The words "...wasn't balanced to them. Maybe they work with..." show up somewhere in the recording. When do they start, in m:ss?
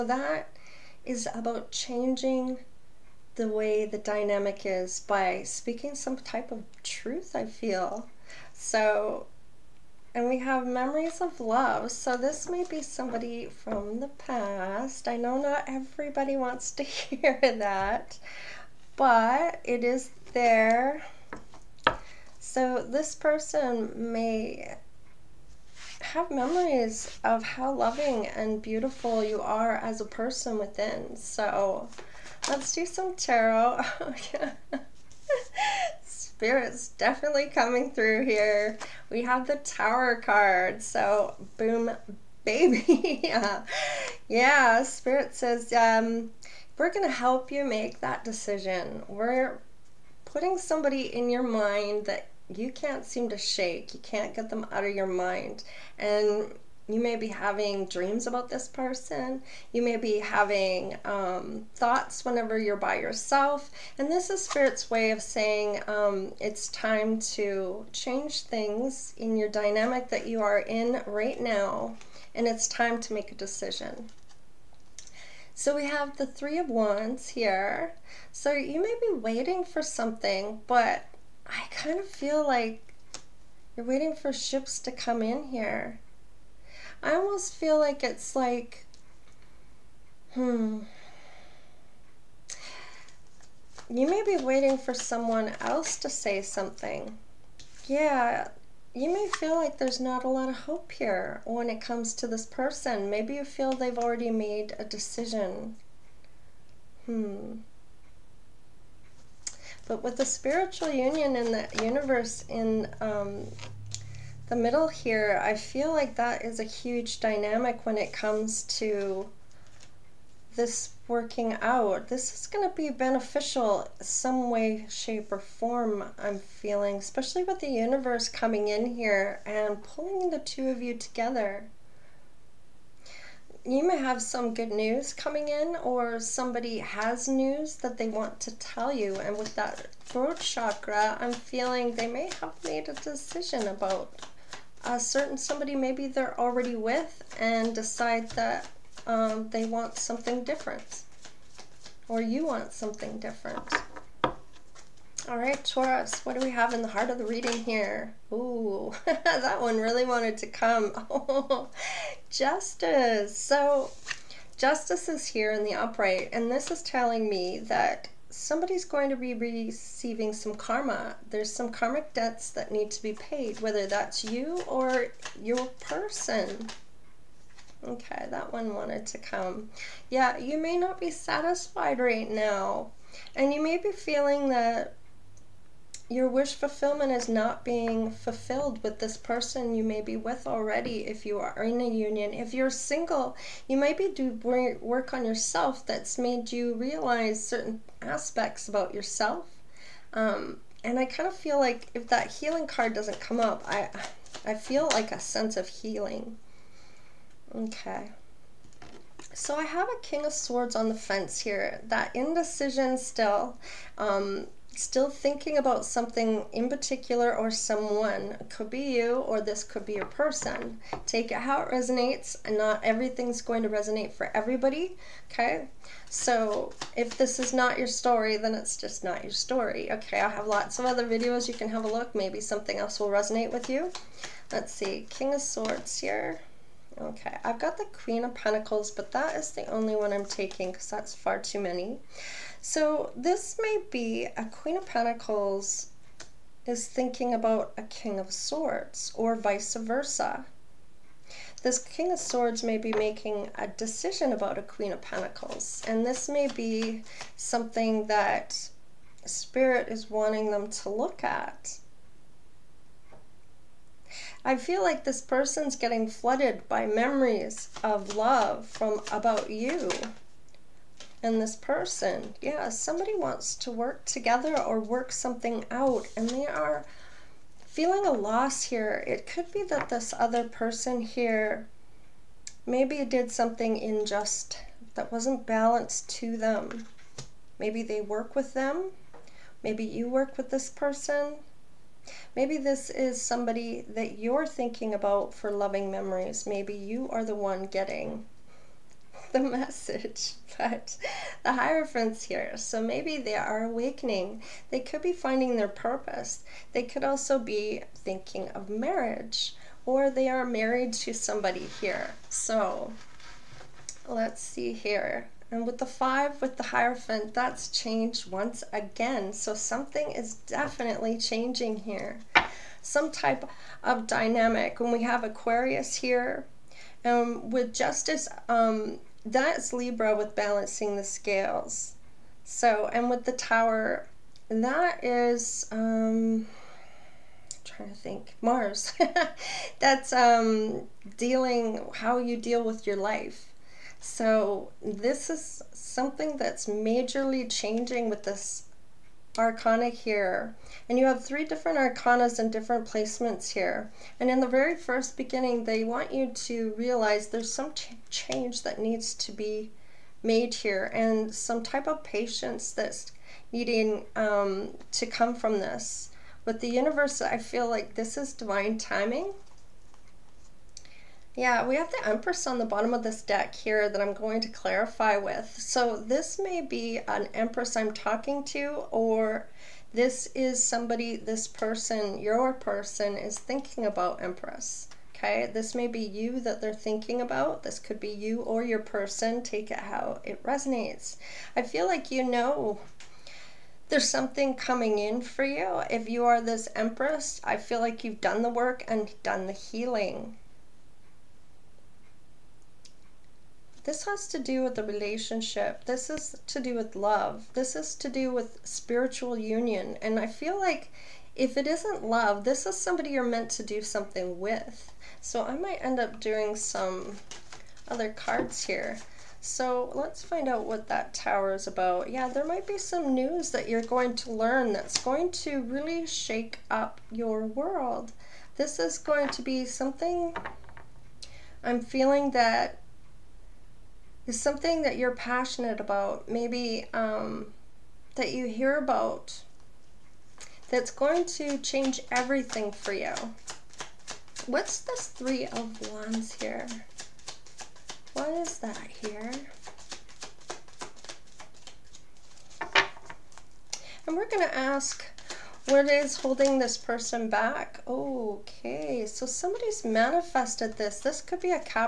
4:45.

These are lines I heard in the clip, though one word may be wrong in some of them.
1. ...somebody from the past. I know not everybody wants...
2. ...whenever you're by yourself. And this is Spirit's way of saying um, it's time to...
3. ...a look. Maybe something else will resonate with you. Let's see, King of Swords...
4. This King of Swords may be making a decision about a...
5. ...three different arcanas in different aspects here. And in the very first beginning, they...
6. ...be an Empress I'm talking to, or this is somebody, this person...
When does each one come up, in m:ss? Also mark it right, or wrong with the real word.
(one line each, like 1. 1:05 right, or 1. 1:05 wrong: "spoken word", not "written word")
1. 0:12 right
2. 1:02 right
3. 3:51 right
4. 4:11 right
5. 5:51 wrong: "placements", not "aspects"
6. 6:16 right.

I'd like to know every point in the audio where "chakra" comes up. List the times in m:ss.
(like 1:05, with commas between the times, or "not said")
2:20.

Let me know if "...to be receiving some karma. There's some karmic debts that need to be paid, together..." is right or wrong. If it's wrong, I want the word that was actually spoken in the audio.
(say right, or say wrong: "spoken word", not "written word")
wrong: "whether", not "together".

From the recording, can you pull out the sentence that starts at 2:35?
All right, Taurus, what do we have in the heart of the reading here?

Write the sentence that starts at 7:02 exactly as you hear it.
Yeah, there might be some news that you're going to learn that's going to really shake up your world.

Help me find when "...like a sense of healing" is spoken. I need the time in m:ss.
3:24.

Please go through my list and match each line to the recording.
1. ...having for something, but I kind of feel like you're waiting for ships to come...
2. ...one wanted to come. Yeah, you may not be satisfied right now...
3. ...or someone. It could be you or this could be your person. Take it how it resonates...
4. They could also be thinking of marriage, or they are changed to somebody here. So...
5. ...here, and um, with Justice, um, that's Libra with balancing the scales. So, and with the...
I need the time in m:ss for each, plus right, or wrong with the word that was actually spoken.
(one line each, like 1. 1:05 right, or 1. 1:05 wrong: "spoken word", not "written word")
1. 1:19 wrong: "waiting", not "having"
2. 2:58 right
3. 3:37 right
4. 5:06 wrong: "married", not "changed"
5. 5:25 right.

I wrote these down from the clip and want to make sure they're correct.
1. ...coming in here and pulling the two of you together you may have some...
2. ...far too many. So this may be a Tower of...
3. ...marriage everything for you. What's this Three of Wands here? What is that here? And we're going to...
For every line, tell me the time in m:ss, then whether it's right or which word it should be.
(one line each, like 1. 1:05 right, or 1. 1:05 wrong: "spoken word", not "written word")
1. 2:08 right
2. 4:01 wrong: "Queen", not "Tower"
3. 7:21 wrong: "change", not "marriage".